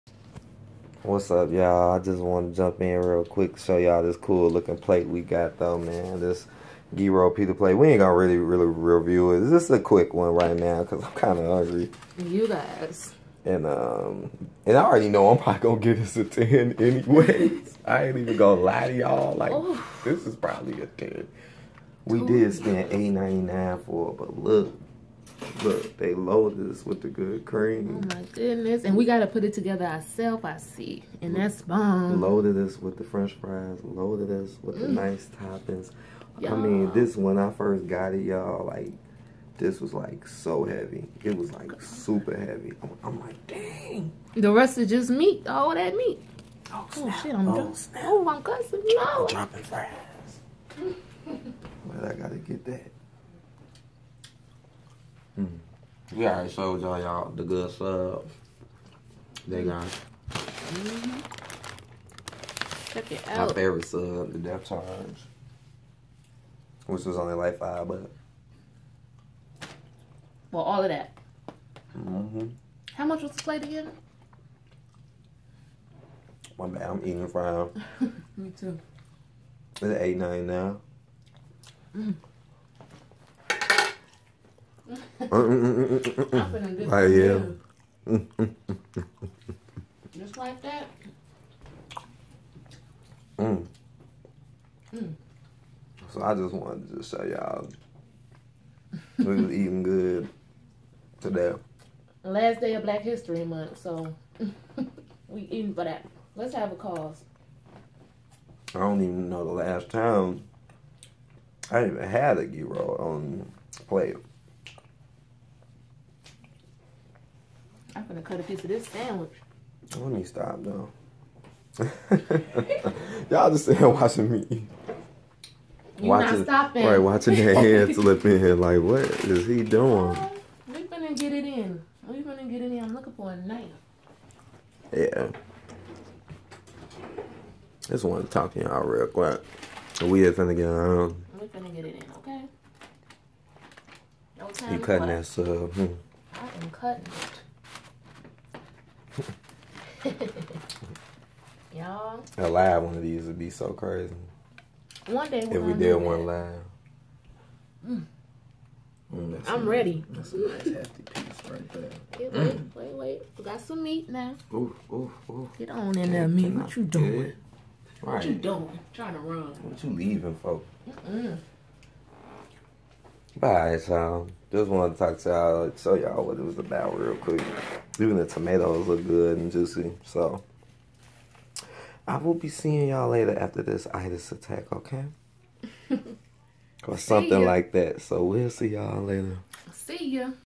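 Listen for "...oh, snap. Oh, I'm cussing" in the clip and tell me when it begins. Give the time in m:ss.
0:47.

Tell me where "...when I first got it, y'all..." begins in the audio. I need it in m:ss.
0:37.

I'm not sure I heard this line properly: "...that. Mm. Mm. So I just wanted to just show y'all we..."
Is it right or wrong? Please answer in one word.
right.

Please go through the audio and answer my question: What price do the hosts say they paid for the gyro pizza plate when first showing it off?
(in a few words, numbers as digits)
$8.99.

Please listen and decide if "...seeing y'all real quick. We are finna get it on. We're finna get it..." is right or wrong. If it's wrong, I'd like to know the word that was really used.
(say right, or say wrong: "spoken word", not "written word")
wrong: "talking", not "seeing".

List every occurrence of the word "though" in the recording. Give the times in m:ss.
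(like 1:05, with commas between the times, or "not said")
0:05, 2:00.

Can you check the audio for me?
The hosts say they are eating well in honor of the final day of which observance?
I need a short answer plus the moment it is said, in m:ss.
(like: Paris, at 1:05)
Black History Month, at 1:42.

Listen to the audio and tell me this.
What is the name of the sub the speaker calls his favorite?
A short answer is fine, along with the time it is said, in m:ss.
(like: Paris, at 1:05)
depth charge, at 1:04.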